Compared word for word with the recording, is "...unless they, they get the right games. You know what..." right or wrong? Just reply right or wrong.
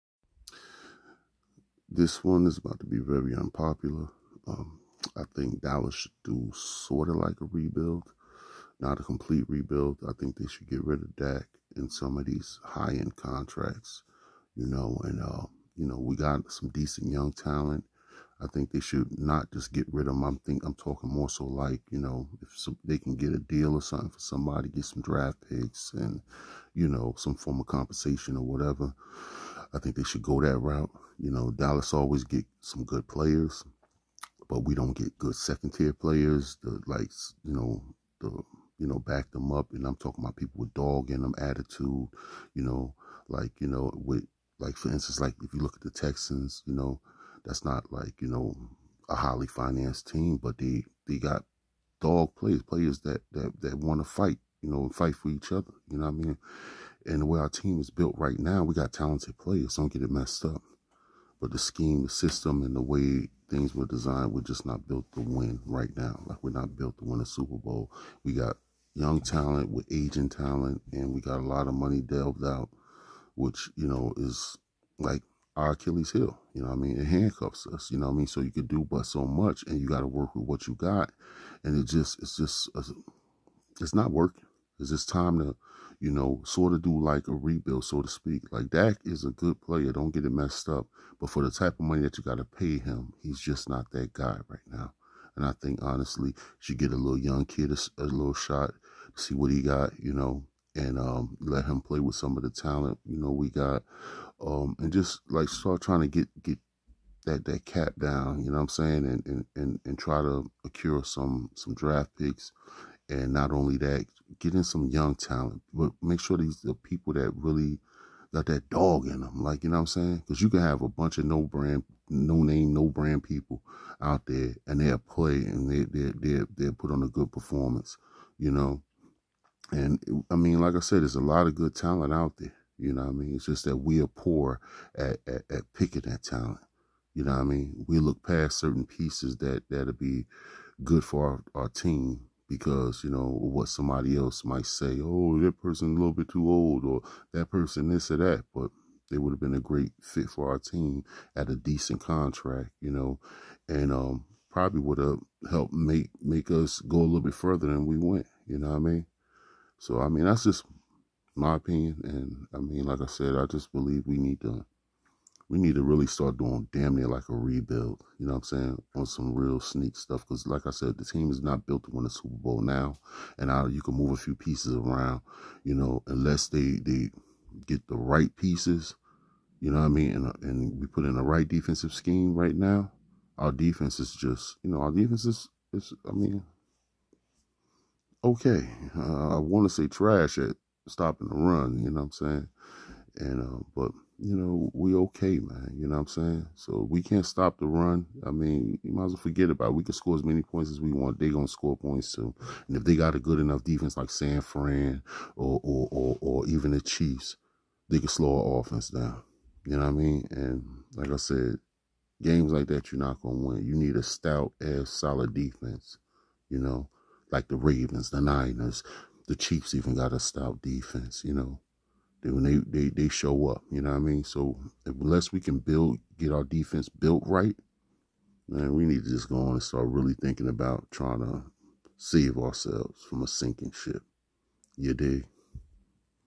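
wrong.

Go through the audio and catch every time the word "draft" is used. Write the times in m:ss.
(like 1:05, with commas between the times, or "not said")
0:25, 1:51.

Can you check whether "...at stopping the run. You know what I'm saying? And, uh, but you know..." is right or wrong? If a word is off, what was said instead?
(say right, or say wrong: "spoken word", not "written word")
right.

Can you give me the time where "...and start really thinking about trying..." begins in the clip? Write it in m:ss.
3:49.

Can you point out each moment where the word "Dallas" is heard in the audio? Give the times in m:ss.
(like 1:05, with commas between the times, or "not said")
0:05, 0:31.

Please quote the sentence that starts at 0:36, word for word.
The like, you know, the you know, back them up.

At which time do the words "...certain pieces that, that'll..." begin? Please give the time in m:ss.
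2:18.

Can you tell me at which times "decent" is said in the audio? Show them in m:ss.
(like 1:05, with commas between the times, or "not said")
0:16, 2:31.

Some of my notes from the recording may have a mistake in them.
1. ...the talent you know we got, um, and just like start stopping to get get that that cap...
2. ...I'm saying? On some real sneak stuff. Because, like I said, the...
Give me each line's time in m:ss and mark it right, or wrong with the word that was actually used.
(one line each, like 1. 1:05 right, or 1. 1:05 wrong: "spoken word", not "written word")
1. 1:42 wrong: "trying", not "stopping"
2. 2:48 right.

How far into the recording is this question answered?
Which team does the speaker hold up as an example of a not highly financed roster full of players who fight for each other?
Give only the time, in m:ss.
0:45.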